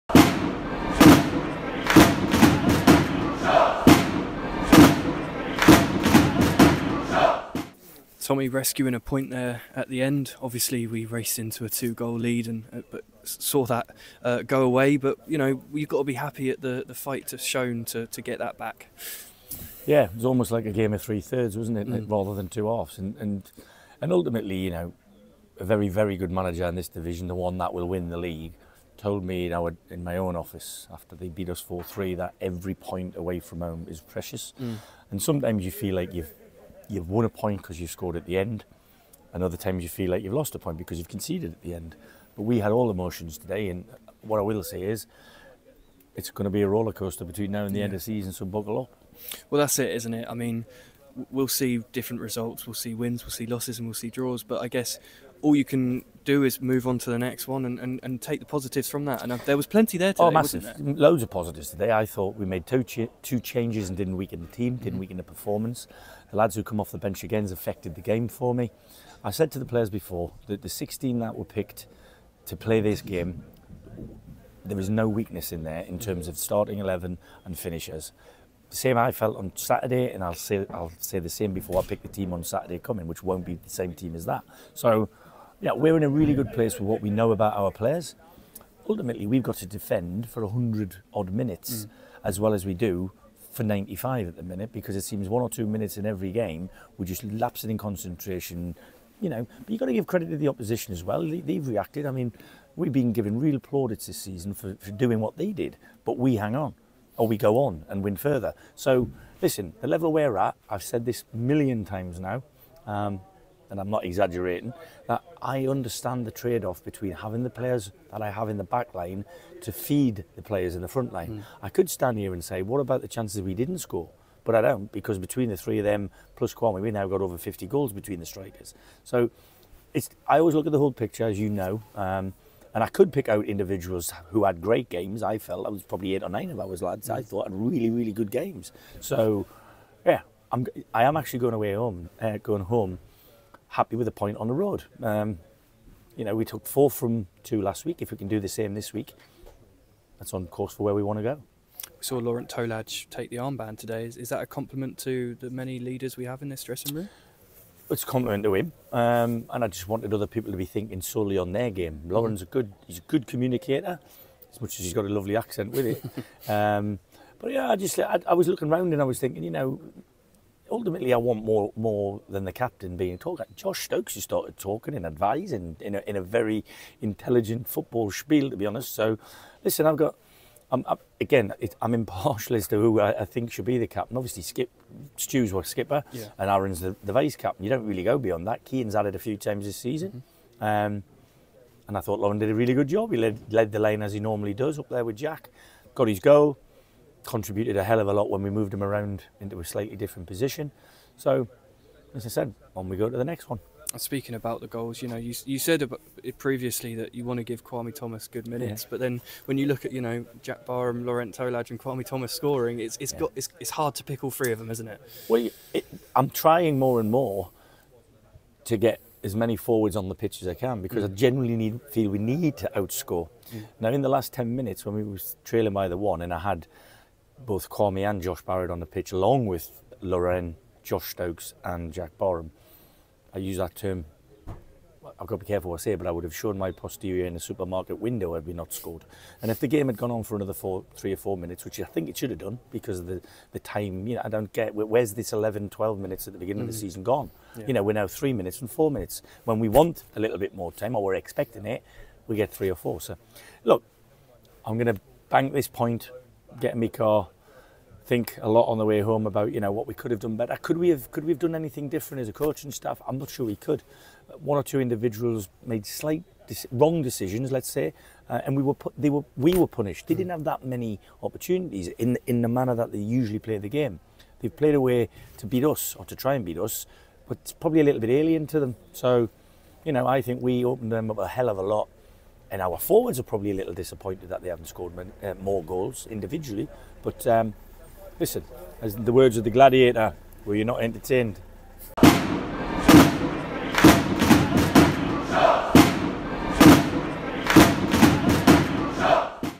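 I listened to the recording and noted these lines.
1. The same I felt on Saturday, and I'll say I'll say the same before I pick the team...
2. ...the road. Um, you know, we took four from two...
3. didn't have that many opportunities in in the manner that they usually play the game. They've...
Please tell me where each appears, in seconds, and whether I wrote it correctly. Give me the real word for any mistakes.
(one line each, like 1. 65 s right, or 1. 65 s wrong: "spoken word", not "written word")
1. 78 s right
2. 144 s right
3. 270 s right.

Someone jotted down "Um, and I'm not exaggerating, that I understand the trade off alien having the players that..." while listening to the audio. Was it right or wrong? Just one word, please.
wrong.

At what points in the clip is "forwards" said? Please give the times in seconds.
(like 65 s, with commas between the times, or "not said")
219 s, 282 s.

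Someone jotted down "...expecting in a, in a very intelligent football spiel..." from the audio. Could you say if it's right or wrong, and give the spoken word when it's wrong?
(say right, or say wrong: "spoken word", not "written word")
wrong: "advising", not "expecting".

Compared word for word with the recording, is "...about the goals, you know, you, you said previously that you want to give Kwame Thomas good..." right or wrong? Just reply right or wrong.
right.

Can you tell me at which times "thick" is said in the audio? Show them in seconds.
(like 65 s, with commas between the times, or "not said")
not said.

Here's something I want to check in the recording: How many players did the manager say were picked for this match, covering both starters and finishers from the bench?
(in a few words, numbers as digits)
16.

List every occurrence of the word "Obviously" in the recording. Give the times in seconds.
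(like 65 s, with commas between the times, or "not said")
10 s, 184 s.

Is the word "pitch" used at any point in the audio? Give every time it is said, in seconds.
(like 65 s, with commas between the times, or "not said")
220 s, 228 s.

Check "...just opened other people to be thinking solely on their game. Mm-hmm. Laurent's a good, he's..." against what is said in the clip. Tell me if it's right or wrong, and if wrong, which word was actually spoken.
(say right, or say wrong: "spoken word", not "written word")
wrong: "wanted", not "opened".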